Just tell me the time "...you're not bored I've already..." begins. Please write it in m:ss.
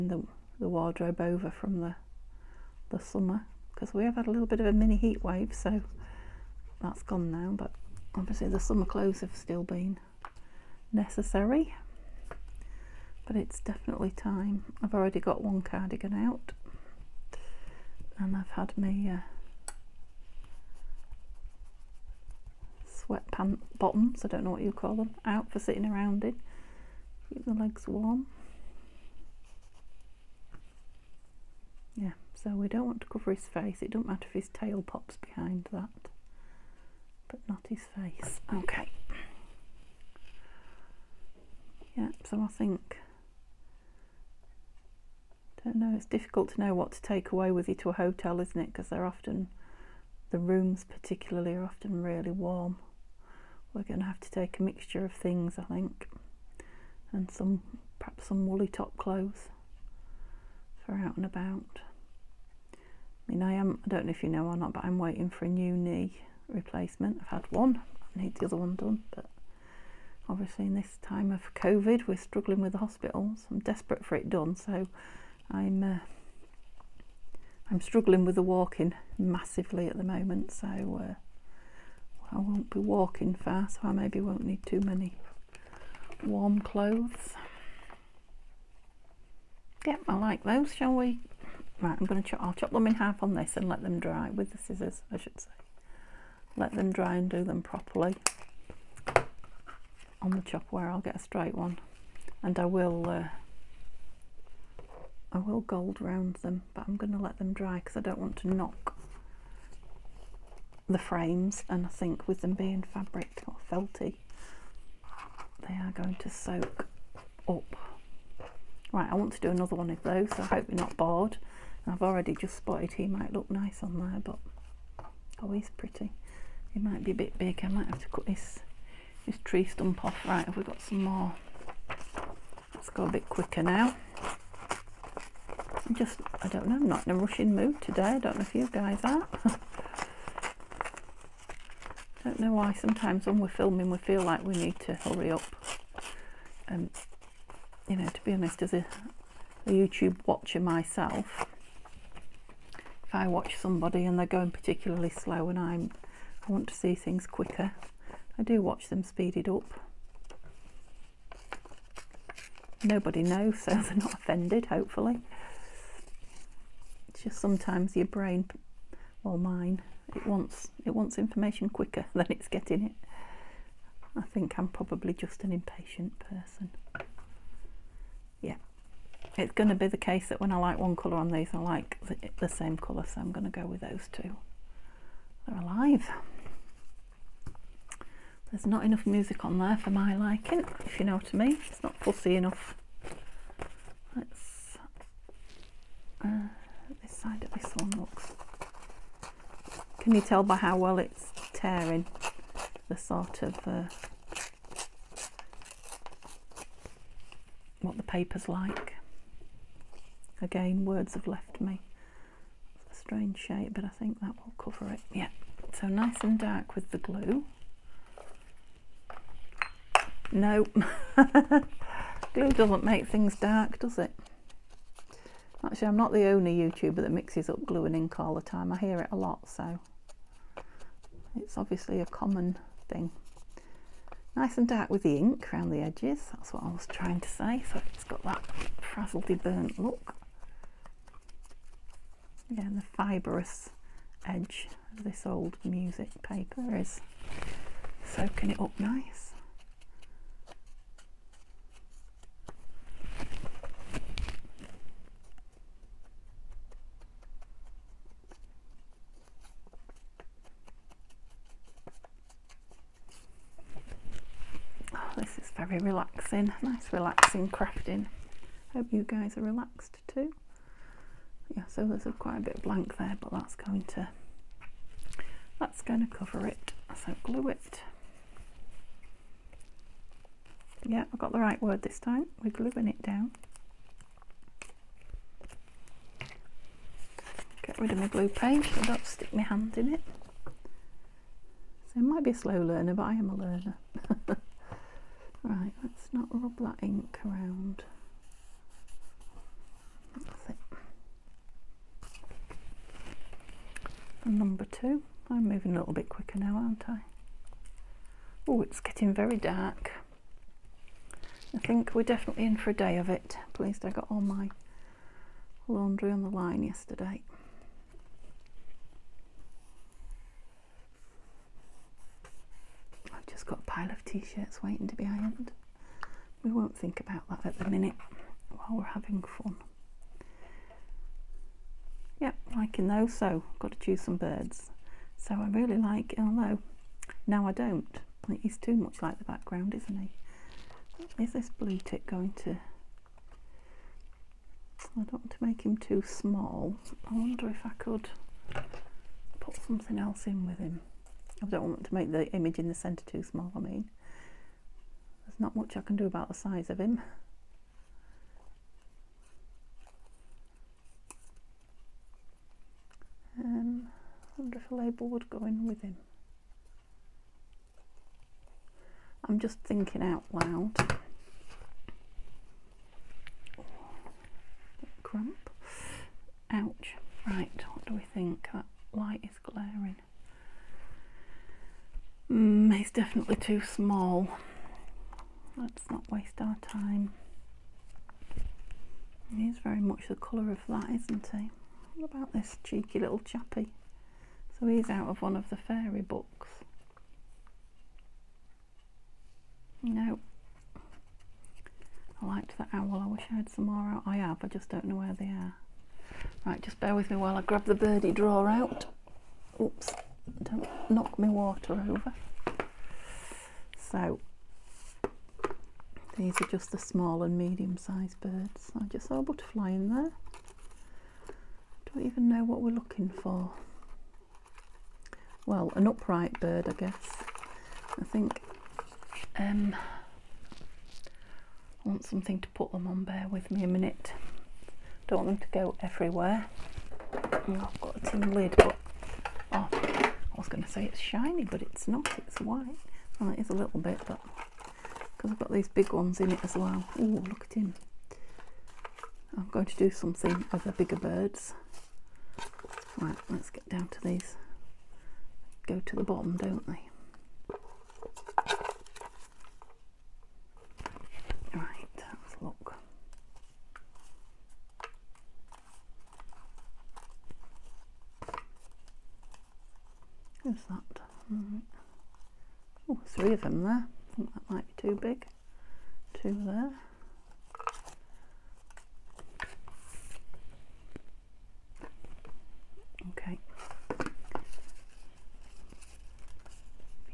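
2:00.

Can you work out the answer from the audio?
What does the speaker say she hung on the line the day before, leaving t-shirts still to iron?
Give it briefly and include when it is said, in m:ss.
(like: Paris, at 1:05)
laundry, at 5:15.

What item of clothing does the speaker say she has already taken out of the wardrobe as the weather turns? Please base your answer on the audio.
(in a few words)
cardigan.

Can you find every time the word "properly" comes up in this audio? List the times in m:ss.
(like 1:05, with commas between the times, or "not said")
1:37.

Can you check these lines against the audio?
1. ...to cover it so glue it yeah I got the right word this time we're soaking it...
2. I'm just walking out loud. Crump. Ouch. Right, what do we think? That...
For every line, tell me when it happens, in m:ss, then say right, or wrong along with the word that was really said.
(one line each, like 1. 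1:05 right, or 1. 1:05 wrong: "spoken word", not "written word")
1. 4:36 wrong: "gluing", not "soaking"
2. 6:09 wrong: "thinking", not "walking".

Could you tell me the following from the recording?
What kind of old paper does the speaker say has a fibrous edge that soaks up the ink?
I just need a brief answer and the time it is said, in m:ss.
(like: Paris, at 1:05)
music paper, at 4:05.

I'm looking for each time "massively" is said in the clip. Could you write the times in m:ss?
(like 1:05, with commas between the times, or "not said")
1:19.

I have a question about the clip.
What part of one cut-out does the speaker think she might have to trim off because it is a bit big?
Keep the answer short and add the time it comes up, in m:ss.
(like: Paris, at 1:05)
tree stump, at 2:09.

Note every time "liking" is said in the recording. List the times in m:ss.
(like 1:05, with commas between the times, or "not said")
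3:10, 5:32.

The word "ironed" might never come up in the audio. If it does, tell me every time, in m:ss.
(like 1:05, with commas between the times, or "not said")
5:25.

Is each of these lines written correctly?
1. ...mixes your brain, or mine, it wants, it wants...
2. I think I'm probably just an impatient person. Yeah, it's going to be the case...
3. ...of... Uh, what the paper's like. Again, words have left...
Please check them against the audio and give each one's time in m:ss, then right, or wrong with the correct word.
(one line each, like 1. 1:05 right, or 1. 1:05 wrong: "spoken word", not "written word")
1. 2:47 wrong: "sometimes", not "mixes"
2. 2:54 right
3. 3:23 right.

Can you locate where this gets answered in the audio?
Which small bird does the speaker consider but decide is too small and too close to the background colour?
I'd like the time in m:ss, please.
5:41.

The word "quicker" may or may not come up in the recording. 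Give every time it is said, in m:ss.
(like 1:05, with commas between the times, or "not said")
2:13, 2:37, 2:51, 5:06.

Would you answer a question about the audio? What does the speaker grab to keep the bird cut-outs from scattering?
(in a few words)
a tin lid.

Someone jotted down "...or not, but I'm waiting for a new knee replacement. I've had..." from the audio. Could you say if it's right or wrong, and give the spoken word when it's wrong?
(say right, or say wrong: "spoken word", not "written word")
right.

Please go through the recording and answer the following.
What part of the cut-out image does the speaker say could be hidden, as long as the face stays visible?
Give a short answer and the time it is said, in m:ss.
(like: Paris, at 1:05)
his tail, at 0:34.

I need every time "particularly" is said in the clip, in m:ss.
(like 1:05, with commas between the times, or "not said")
0:50, 2:34.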